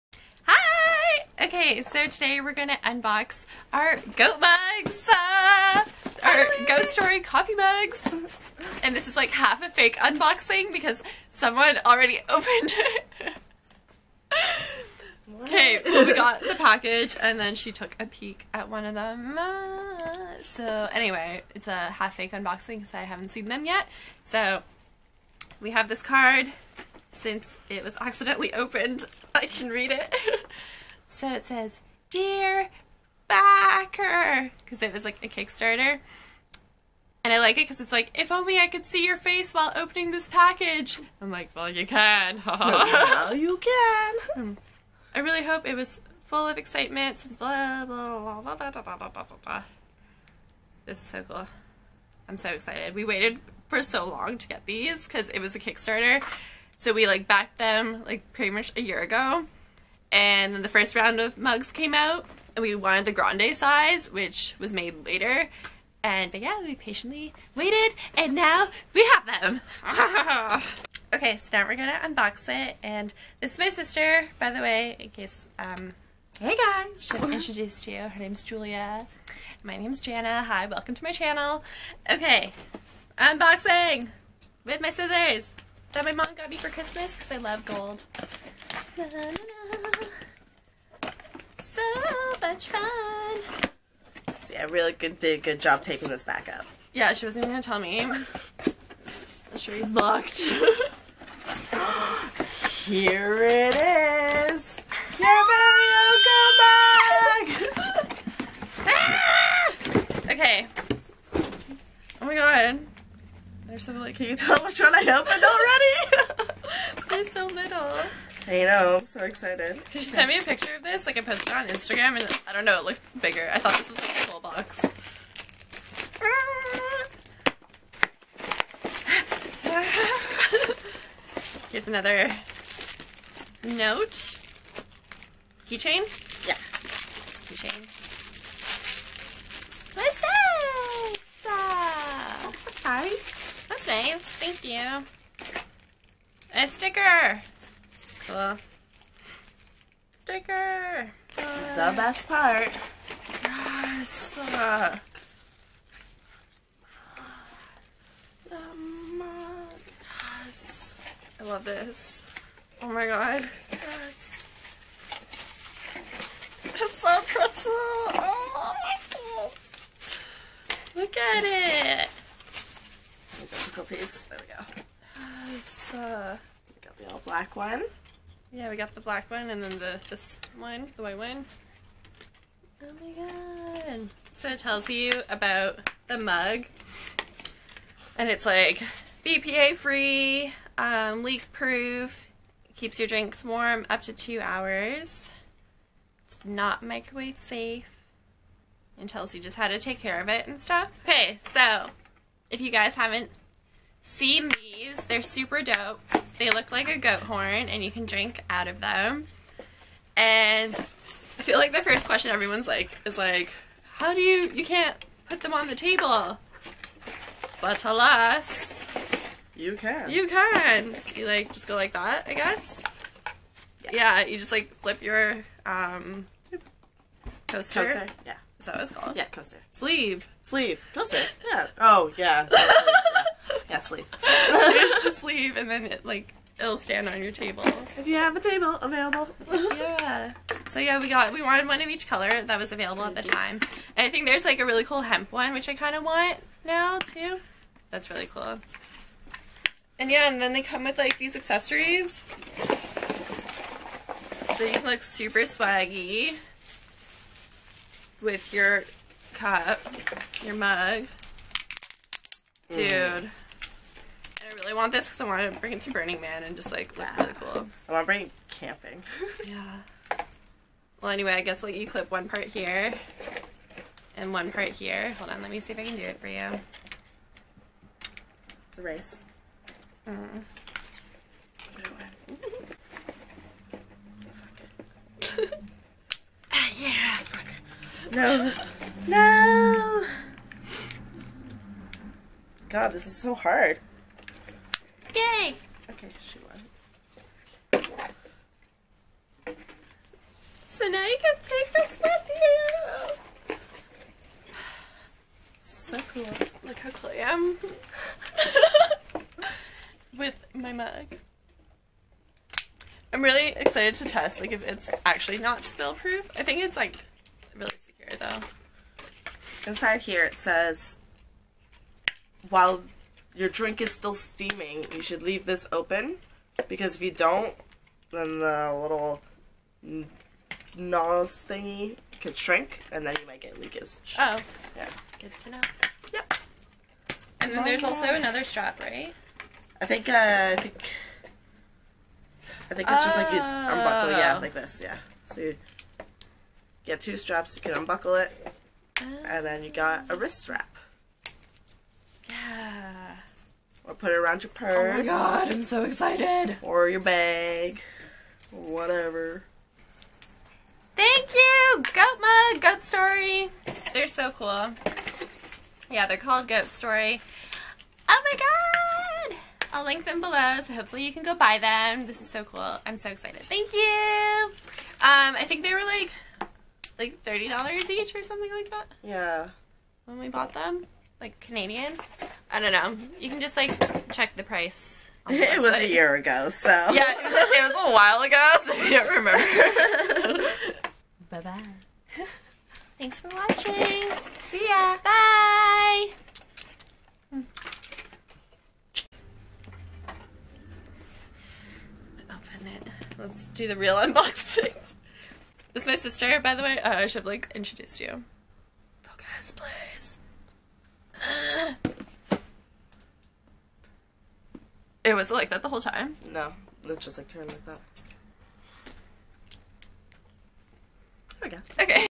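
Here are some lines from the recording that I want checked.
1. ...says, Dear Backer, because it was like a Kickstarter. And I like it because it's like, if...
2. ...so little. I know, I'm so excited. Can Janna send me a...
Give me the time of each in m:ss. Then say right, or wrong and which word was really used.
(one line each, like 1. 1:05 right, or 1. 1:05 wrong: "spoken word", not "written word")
1. 0:31 right
2. 1:57 wrong: "She", not "Janna".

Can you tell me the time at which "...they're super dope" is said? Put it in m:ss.
3:25.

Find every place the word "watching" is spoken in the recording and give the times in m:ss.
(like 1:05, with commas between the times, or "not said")
6:33.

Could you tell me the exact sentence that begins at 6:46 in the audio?
Uh, I should have like introduced you.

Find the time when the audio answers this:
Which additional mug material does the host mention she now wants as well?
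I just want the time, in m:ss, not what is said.
4:05.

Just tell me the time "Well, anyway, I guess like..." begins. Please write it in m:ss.
4:31.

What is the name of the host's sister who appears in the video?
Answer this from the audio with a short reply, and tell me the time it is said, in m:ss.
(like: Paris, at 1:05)
Julia, at 1:18.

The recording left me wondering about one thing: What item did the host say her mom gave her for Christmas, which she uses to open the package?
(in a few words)
Scissors.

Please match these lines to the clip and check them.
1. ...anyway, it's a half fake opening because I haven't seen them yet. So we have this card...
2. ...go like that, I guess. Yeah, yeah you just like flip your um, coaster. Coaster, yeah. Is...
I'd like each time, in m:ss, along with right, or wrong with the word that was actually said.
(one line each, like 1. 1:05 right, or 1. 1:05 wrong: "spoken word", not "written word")
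1. 0:20 wrong: "unboxing", not "opening"
2. 3:41 right.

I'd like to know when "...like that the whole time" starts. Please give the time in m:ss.
6:55.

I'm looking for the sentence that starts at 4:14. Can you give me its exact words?
So you can look super swaggy with your cup, your mug.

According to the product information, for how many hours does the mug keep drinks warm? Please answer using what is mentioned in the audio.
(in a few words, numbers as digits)
2.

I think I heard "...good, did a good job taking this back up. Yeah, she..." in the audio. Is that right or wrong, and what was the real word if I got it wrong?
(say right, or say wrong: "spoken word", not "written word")
right.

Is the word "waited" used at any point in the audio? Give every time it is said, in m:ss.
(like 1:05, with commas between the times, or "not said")
0:53, 1:07.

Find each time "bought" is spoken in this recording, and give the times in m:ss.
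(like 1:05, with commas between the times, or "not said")
6:20.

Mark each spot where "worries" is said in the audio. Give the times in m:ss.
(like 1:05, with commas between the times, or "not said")
not said.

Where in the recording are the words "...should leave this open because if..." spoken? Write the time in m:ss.
5:25.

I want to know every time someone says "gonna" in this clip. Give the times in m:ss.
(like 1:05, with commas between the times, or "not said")
0:02, 1:11, 1:37.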